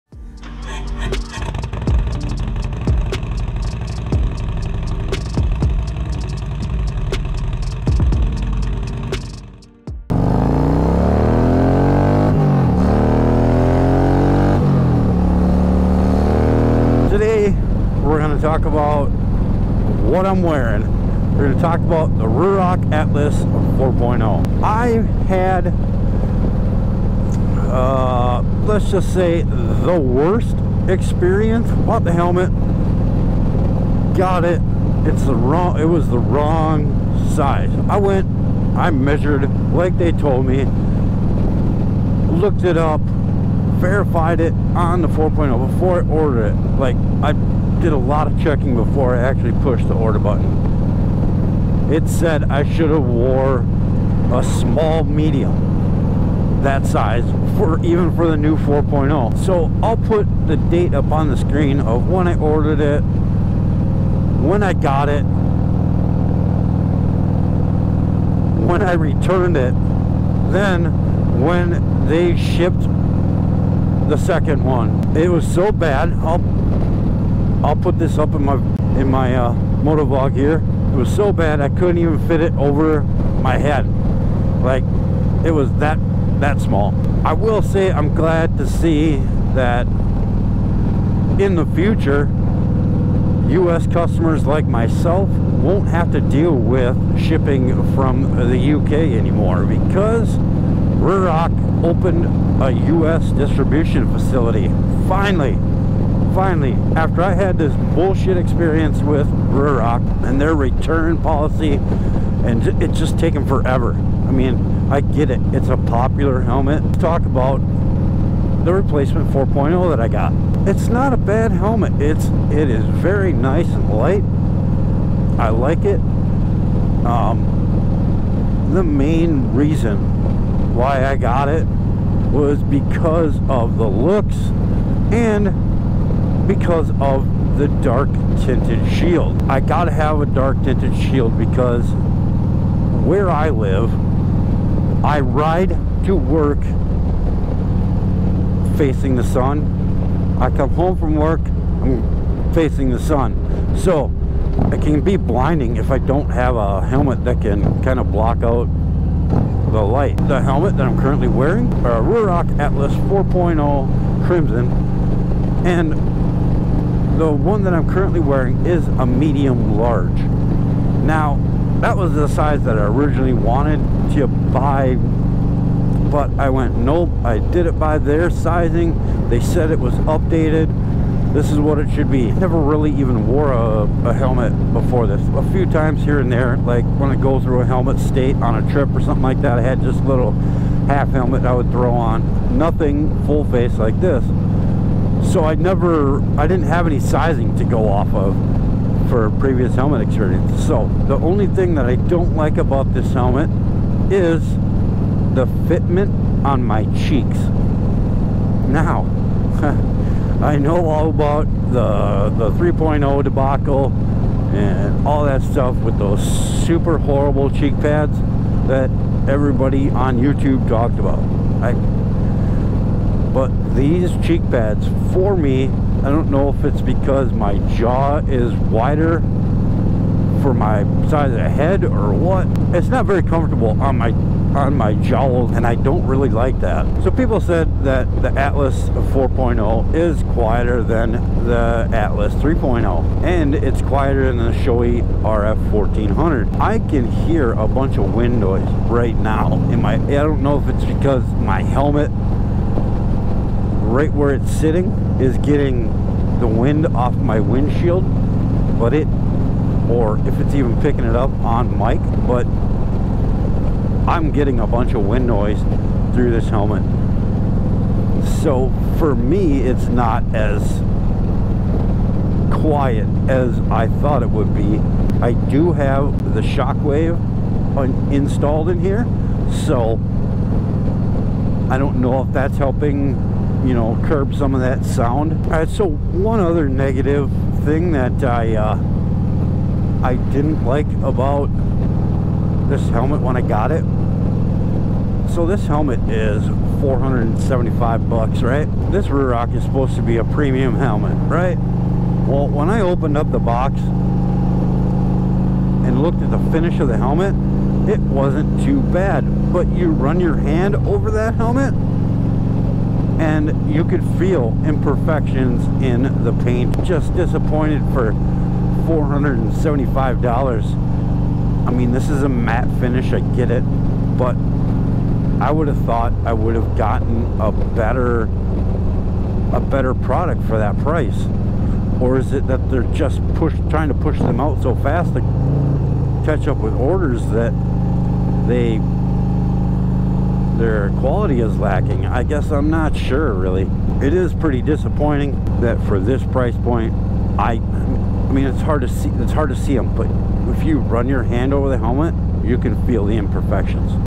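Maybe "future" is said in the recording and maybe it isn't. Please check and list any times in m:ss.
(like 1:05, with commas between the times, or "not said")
1:31.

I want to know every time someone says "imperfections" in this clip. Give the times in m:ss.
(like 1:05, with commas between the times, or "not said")
5:14, 5:53.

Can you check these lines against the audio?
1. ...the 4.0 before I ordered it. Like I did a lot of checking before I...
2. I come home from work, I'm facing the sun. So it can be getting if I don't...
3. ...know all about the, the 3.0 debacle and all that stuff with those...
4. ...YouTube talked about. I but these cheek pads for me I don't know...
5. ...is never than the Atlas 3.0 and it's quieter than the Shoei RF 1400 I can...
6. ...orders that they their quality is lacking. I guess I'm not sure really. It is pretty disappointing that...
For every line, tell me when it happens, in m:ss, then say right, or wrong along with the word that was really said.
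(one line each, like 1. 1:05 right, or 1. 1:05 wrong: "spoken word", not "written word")
1. 0:45 right
2. 2:30 wrong: "blinding", not "getting"
3. 3:30 right
4. 3:40 right
5. 3:59 wrong: "quieter", not "never"
6. 5:36 right.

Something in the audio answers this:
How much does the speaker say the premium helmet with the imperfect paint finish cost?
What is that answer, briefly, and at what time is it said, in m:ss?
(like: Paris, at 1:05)
$475, at 4:56.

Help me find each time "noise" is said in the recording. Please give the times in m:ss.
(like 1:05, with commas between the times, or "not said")
4:08, 4:25.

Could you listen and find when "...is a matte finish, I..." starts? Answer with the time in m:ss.
5:22.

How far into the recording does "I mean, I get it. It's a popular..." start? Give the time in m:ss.
1:53.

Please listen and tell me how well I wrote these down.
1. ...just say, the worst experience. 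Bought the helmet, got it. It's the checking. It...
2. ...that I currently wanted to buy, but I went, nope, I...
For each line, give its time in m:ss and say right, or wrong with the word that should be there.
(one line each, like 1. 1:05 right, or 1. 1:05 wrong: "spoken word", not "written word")
1. 0:28 wrong: "wrong", not "checking"
2. 2:52 wrong: "originally", not "currently".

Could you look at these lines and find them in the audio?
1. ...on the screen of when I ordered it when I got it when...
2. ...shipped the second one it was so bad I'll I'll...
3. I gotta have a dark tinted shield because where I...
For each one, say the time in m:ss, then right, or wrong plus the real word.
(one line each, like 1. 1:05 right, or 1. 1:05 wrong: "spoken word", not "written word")
1. 1:01 right
2. 1:12 right
3. 2:19 right.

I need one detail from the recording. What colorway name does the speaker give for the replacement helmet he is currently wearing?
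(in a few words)
Crimson.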